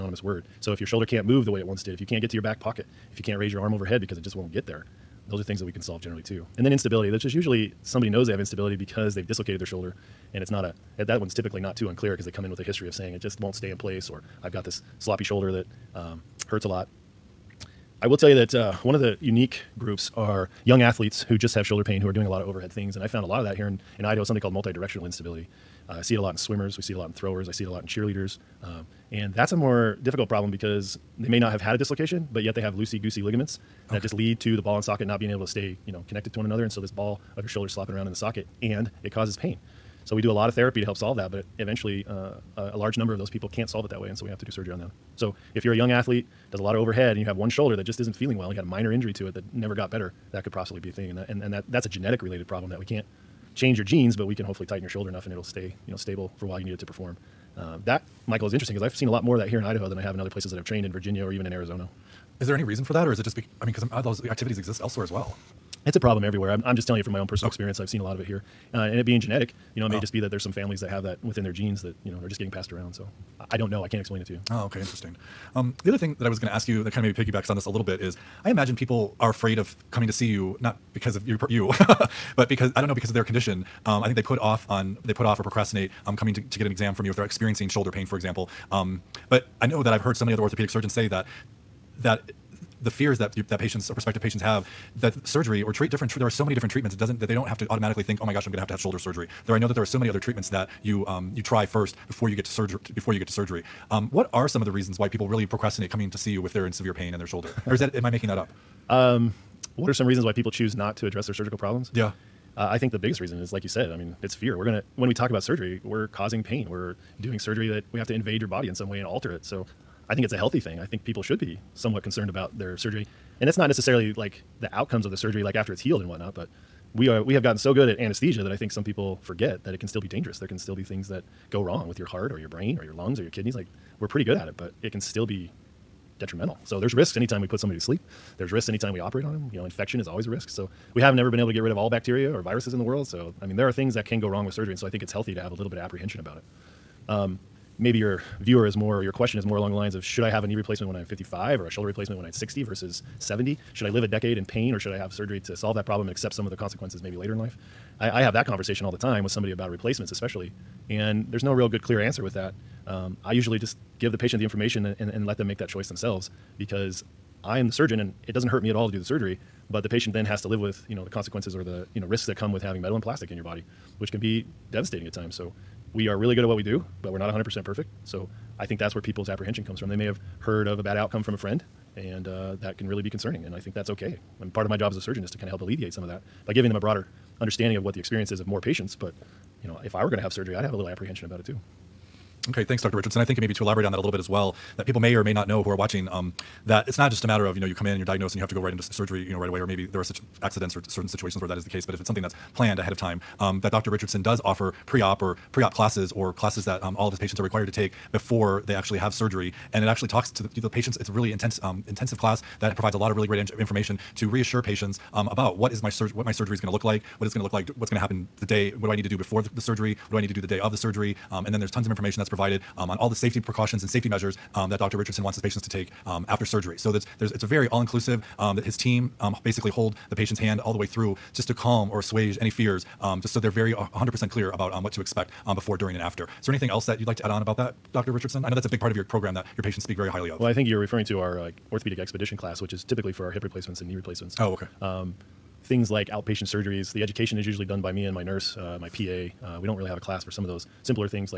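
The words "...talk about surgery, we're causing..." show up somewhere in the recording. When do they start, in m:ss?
1:55.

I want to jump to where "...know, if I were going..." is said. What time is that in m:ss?
3:09.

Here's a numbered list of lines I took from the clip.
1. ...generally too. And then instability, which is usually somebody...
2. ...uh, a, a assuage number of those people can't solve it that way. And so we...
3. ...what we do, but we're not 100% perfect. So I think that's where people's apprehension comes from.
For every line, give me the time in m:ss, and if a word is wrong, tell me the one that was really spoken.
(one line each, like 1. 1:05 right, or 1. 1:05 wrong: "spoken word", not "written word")
1. 0:05 right
2. 0:42 wrong: "large", not "assuage"
3. 2:56 right.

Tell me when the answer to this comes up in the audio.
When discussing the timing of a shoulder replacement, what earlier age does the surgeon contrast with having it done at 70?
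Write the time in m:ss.
2:32.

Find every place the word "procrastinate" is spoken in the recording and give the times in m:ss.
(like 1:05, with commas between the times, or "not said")
1:25, 1:45.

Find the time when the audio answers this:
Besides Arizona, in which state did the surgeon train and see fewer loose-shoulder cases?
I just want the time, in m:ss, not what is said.
1:00.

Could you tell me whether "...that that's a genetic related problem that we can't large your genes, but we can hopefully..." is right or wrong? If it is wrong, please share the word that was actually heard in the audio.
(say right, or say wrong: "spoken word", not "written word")
wrong: "change", not "large".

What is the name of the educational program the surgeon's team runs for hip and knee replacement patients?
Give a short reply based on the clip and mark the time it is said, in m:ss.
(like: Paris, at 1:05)
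orthopedic expedition, at 4:01.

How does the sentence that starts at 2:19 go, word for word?
You know, infection is always a risk.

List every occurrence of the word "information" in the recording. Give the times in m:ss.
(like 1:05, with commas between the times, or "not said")
2:44, 3:33, 3:41.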